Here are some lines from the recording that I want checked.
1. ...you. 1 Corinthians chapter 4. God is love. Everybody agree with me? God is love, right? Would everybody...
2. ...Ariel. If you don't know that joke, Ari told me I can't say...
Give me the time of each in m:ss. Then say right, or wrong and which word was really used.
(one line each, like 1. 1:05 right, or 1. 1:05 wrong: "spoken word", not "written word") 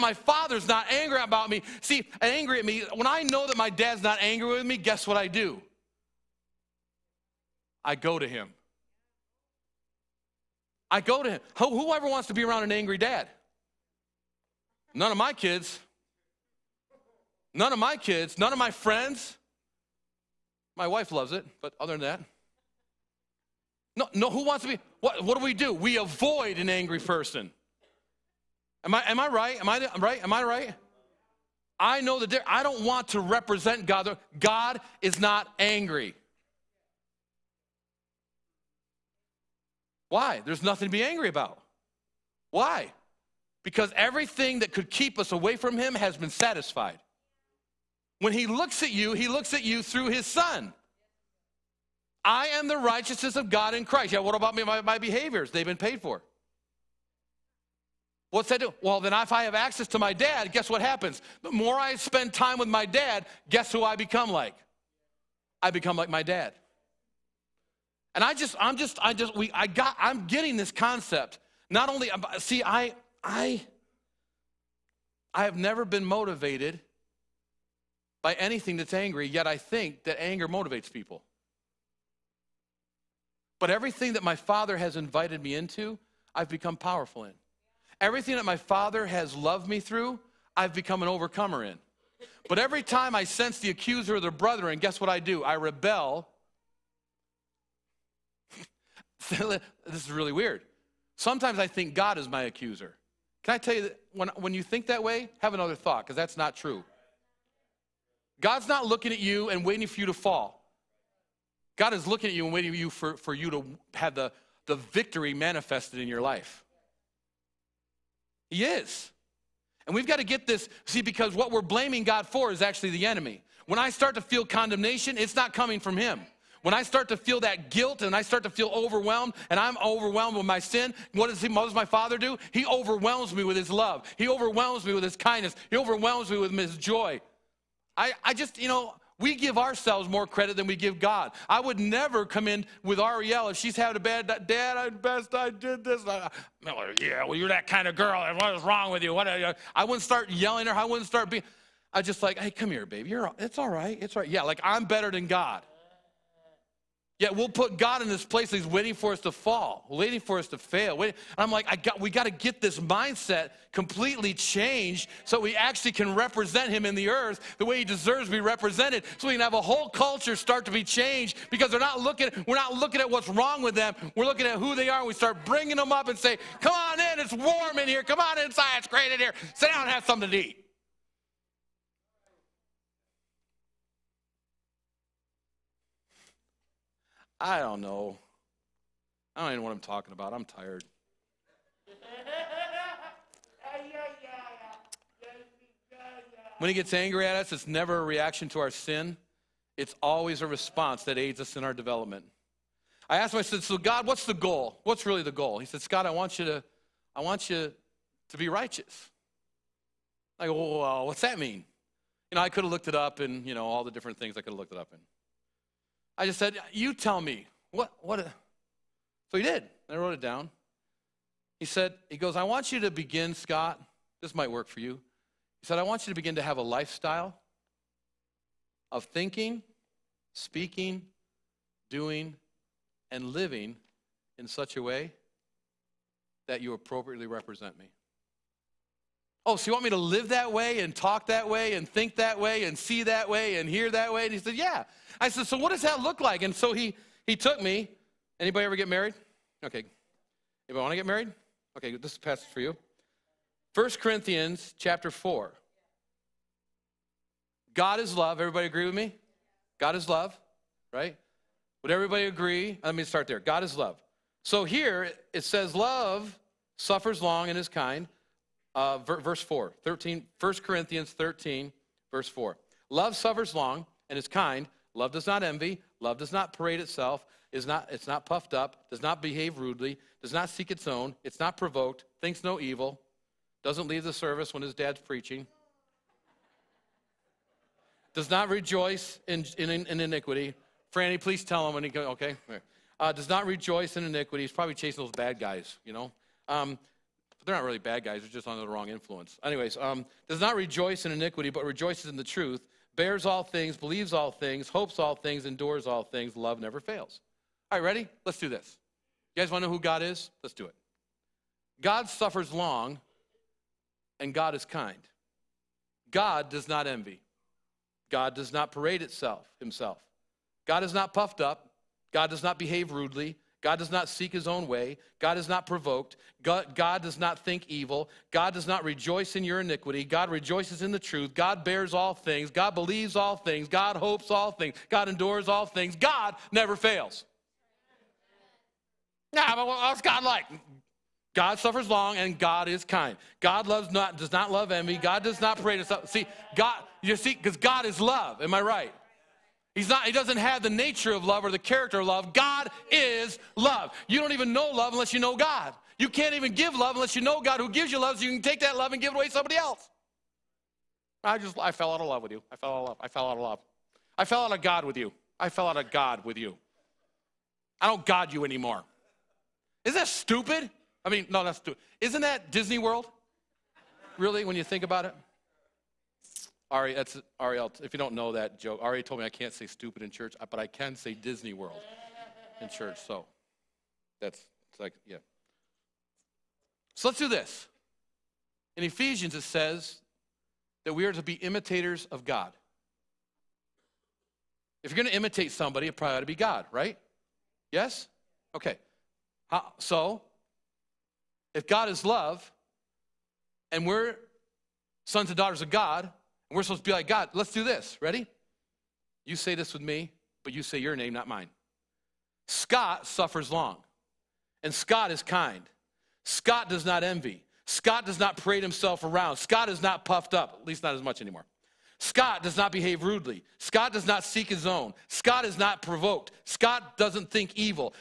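1. 4:12 right
2. 6:17 right.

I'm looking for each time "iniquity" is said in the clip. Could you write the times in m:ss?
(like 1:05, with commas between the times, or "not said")
4:49, 4:54, 5:01, 5:29.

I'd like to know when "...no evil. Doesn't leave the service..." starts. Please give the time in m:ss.
4:42.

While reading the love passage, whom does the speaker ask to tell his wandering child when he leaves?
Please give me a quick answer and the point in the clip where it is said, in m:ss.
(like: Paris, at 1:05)
Franny, at 4:50.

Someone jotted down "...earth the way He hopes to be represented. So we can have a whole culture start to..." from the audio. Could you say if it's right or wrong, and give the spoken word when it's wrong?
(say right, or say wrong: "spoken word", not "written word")
wrong: "deserves", not "hopes".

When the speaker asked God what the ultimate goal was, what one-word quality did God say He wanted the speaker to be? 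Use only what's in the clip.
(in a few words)
Righteous.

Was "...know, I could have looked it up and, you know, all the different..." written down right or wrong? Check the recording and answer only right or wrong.
right.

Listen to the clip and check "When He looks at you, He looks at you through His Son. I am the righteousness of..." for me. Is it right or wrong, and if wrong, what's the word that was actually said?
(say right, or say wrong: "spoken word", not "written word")
right.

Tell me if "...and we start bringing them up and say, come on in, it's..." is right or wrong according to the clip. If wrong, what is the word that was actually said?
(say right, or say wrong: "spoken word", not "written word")
right.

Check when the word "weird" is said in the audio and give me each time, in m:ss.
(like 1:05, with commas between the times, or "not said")
1:40.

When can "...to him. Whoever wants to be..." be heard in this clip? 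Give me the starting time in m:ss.
0:11.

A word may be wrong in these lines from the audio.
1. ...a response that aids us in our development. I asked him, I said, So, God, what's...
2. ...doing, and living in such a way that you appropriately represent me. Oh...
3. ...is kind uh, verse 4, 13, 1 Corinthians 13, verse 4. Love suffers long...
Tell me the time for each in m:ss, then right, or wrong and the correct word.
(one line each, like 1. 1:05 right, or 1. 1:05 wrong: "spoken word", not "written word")
1. 3:20 right
2. 3:51 right
3. 4:27 right.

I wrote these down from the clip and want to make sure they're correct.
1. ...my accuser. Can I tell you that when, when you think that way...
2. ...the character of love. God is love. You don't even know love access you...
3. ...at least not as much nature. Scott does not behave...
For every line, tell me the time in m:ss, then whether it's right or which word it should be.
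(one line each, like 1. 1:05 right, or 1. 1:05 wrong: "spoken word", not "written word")
1. 1:42 right
2. 5:51 wrong: "unless", not "access"
3. 7:00 wrong: "anymore", not "nature".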